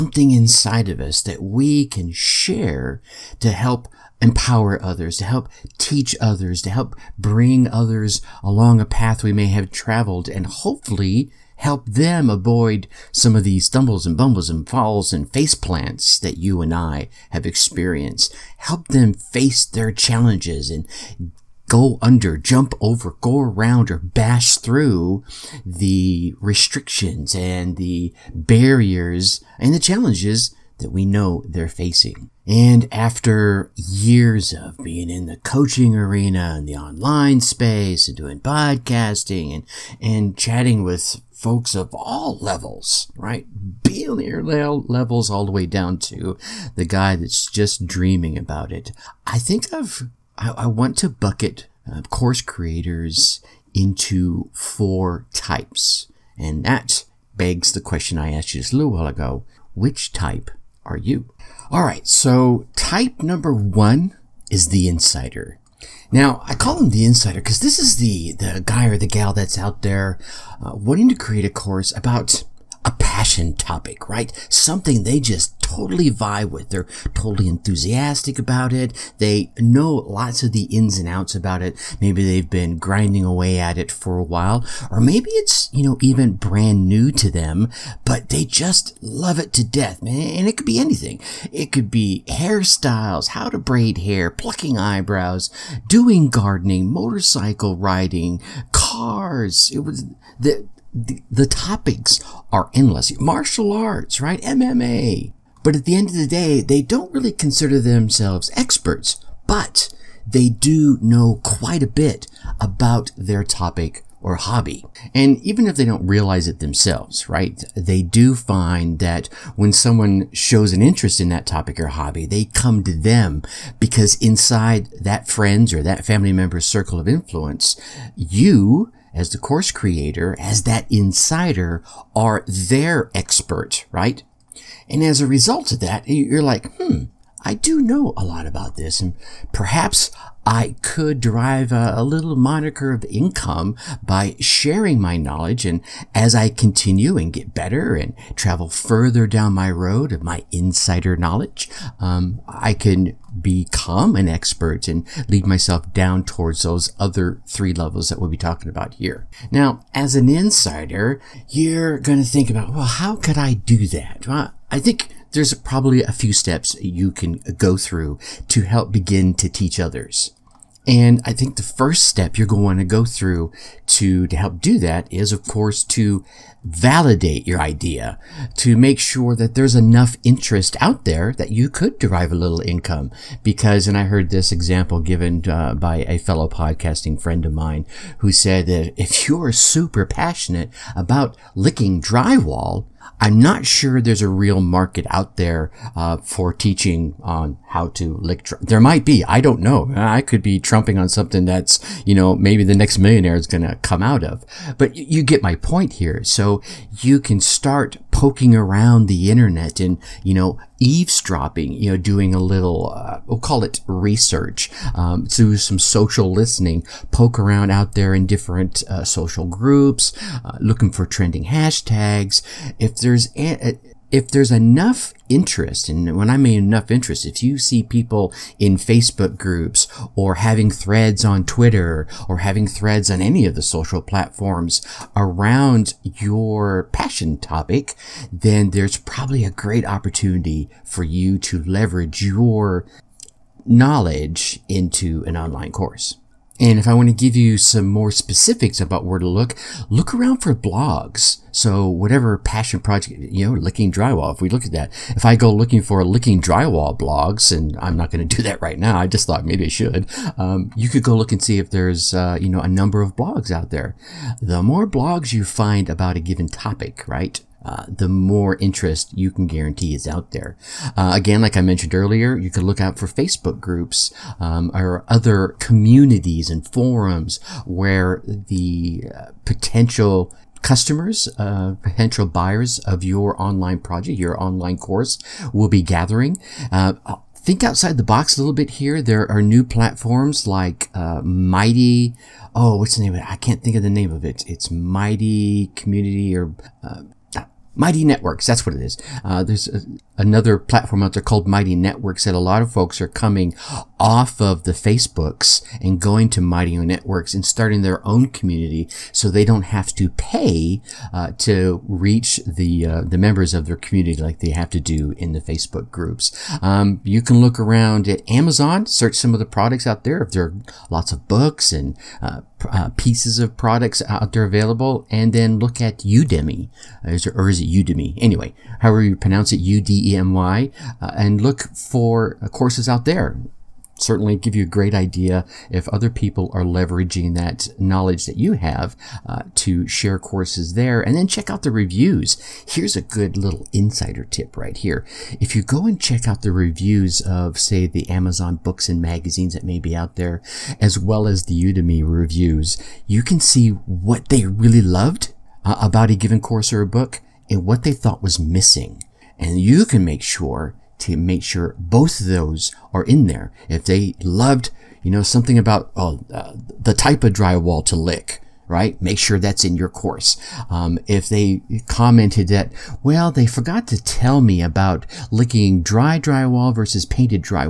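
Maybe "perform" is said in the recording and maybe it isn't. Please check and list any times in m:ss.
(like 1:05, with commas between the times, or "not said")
not said.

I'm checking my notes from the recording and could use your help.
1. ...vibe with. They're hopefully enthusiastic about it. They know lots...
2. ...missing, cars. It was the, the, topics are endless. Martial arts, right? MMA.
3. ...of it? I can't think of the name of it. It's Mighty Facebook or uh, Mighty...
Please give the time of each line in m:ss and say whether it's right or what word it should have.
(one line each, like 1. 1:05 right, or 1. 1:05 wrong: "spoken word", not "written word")
1. 1:16 wrong: "totally", not "hopefully"
2. 1:37 wrong: "riding", not "missing"
3. 4:53 wrong: "Community", not "Facebook".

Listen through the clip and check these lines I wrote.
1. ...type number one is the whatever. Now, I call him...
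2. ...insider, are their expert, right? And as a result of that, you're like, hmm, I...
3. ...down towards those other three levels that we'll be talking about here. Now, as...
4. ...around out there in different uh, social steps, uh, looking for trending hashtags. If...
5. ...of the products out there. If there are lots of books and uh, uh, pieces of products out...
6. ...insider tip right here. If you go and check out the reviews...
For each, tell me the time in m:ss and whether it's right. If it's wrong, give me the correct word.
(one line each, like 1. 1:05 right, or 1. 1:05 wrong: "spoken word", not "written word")
1. 1:02 wrong: "insider", not "whatever"
2. 2:10 right
3. 2:35 right
4. 3:37 wrong: "groups", not "steps"
5. 5:19 right
6. 5:43 right.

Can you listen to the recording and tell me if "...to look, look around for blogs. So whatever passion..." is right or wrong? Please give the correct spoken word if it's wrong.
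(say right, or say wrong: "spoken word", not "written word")
right.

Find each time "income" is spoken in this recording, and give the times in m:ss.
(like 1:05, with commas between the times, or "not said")
2:23, 3:02.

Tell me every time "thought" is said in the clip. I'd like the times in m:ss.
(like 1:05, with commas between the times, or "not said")
4:19, 5:57.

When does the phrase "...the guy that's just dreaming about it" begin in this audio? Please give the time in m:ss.
0:46.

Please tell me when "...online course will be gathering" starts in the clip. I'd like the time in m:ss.
4:44.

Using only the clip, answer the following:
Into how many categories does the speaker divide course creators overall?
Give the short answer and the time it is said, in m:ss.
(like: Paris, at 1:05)
4, at 0:54.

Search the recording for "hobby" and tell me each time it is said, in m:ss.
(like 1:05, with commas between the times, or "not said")
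1:54, 2:01.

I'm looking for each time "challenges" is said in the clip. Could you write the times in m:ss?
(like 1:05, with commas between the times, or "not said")
0:19, 0:29.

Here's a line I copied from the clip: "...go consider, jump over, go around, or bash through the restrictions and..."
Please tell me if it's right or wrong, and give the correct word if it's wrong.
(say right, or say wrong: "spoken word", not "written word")
wrong: "under", not "consider".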